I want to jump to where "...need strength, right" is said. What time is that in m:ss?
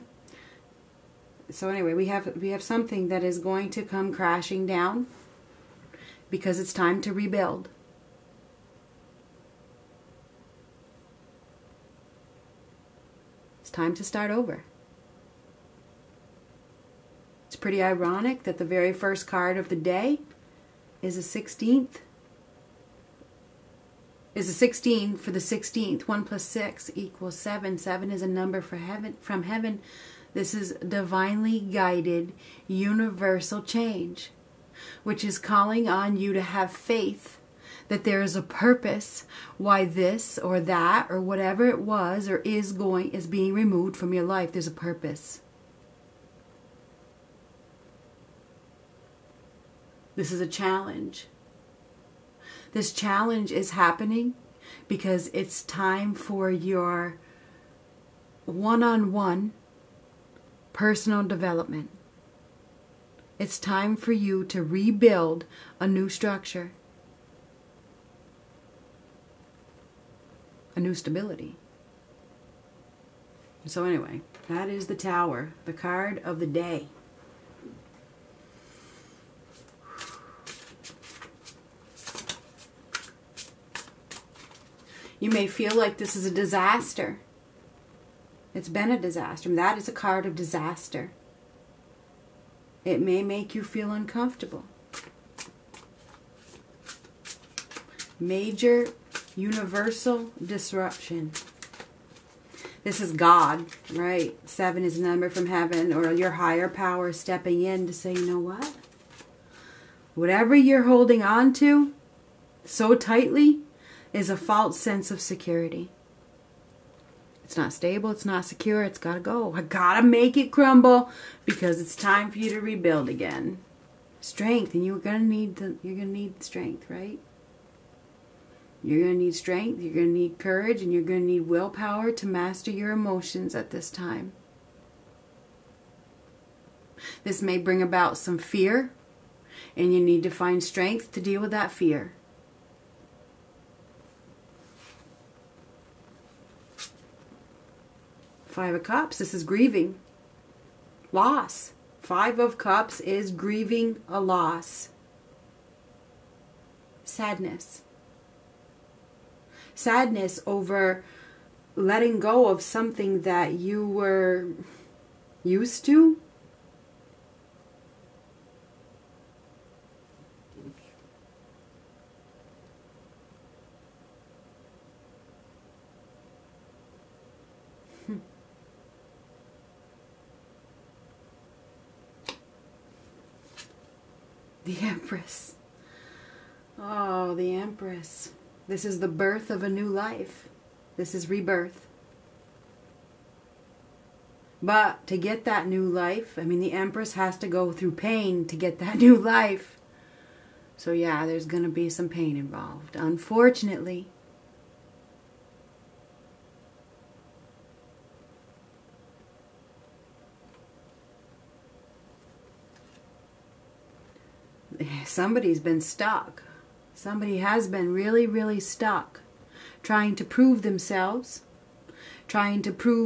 2:06.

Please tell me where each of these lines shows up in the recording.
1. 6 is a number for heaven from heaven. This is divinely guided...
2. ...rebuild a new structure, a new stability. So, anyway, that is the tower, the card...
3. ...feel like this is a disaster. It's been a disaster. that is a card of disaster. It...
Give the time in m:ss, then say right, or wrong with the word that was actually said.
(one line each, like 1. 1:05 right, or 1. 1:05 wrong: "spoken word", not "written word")
1. 0:27 wrong: "7", not "6"
2. 1:04 right
3. 1:25 right.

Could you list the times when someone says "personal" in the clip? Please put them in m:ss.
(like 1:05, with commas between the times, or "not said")
1:00.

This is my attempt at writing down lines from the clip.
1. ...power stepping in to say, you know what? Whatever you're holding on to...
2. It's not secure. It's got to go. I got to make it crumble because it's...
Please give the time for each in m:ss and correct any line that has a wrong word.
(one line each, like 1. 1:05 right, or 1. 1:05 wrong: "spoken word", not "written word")
1. 1:46 right
2. 1:58 right.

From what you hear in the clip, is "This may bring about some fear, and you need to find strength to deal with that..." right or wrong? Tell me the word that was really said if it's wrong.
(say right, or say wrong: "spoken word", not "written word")
right.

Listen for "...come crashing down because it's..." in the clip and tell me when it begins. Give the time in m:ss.
0:03.